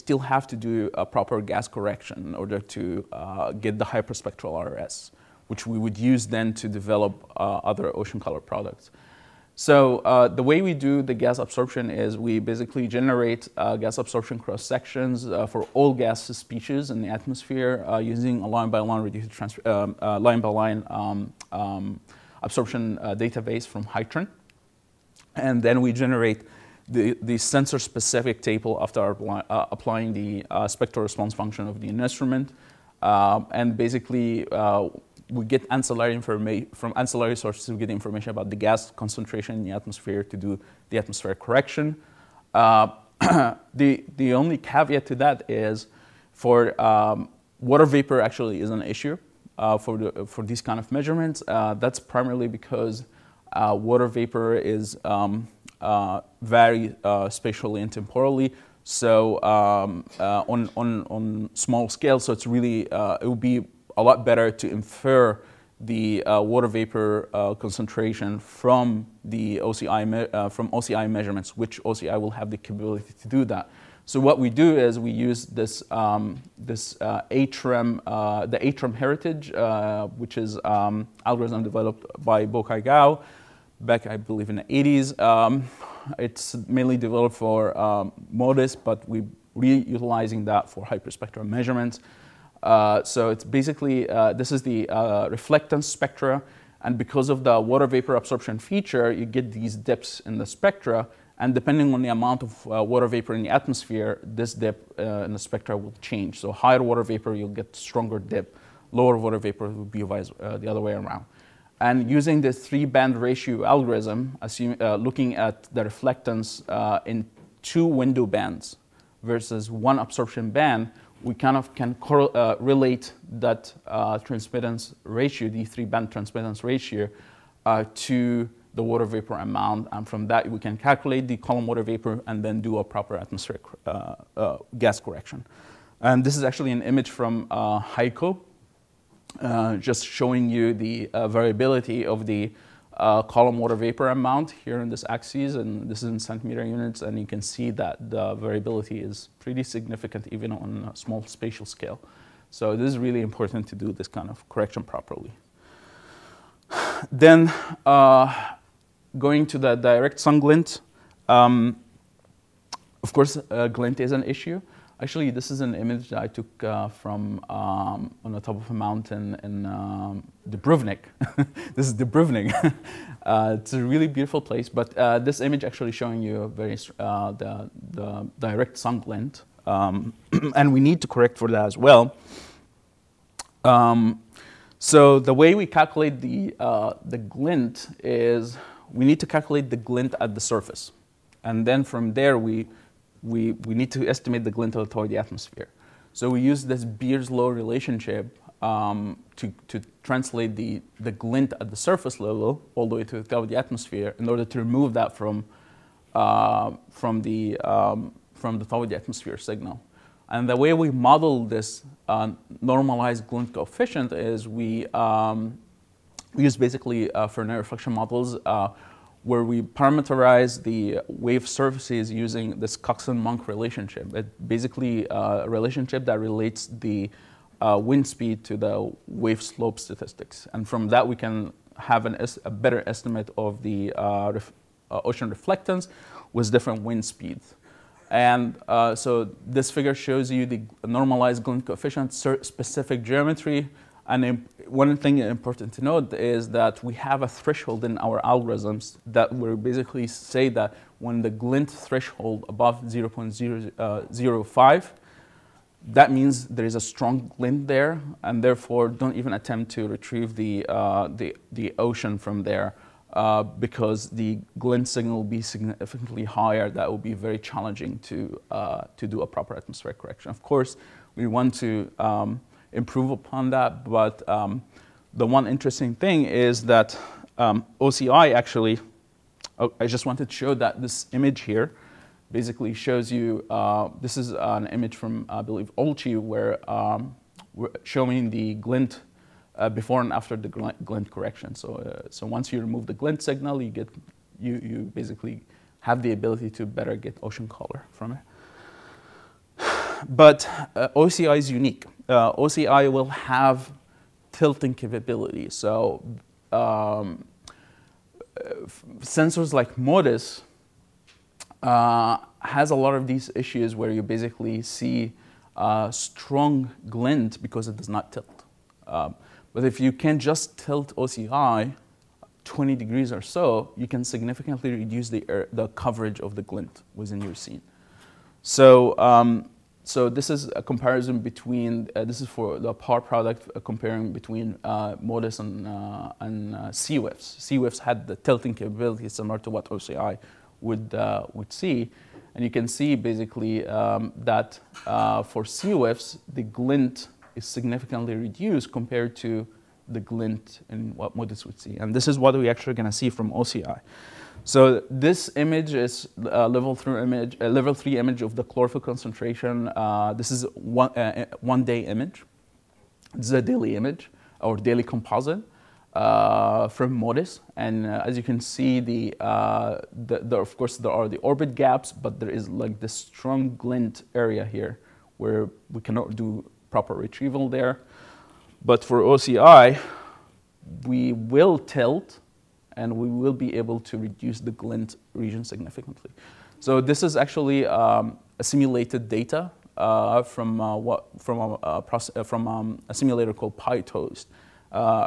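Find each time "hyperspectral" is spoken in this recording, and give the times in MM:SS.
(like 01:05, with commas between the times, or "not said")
00:03, 01:30.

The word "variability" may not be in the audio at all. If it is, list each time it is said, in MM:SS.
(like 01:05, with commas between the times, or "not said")
02:21, 02:28.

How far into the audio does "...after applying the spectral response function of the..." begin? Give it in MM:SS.
00:28.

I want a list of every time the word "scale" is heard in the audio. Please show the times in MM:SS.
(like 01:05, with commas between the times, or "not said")
01:01, 02:31.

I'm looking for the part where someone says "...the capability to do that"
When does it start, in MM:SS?
01:12.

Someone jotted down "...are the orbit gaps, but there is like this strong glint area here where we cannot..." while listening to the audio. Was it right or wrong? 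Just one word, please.
right.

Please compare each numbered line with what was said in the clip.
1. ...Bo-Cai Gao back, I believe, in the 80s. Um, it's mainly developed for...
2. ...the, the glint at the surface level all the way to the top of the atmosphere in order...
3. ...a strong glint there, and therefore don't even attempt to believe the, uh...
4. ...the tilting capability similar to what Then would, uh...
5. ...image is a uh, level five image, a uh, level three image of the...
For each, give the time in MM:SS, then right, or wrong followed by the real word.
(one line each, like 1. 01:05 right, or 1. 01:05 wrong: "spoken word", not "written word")
1. 01:22 right
2. 03:20 right
3. 04:16 wrong: "retrieve", not "believe"
4. 05:38 wrong: "OCI", not "Then"
5. 05:55 wrong: "three", not "five".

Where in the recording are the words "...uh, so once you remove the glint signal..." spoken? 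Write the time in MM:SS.
04:51.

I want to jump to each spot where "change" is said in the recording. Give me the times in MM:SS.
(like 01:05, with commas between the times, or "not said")
01:46.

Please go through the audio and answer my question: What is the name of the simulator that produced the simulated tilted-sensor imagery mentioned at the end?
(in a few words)
PyToast.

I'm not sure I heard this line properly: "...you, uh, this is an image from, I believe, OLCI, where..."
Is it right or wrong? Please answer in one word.
right.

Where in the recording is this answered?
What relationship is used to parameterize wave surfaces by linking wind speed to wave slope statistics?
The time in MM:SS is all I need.
03:42.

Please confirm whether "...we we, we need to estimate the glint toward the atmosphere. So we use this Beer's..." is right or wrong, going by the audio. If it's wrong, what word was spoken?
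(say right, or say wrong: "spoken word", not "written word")
right.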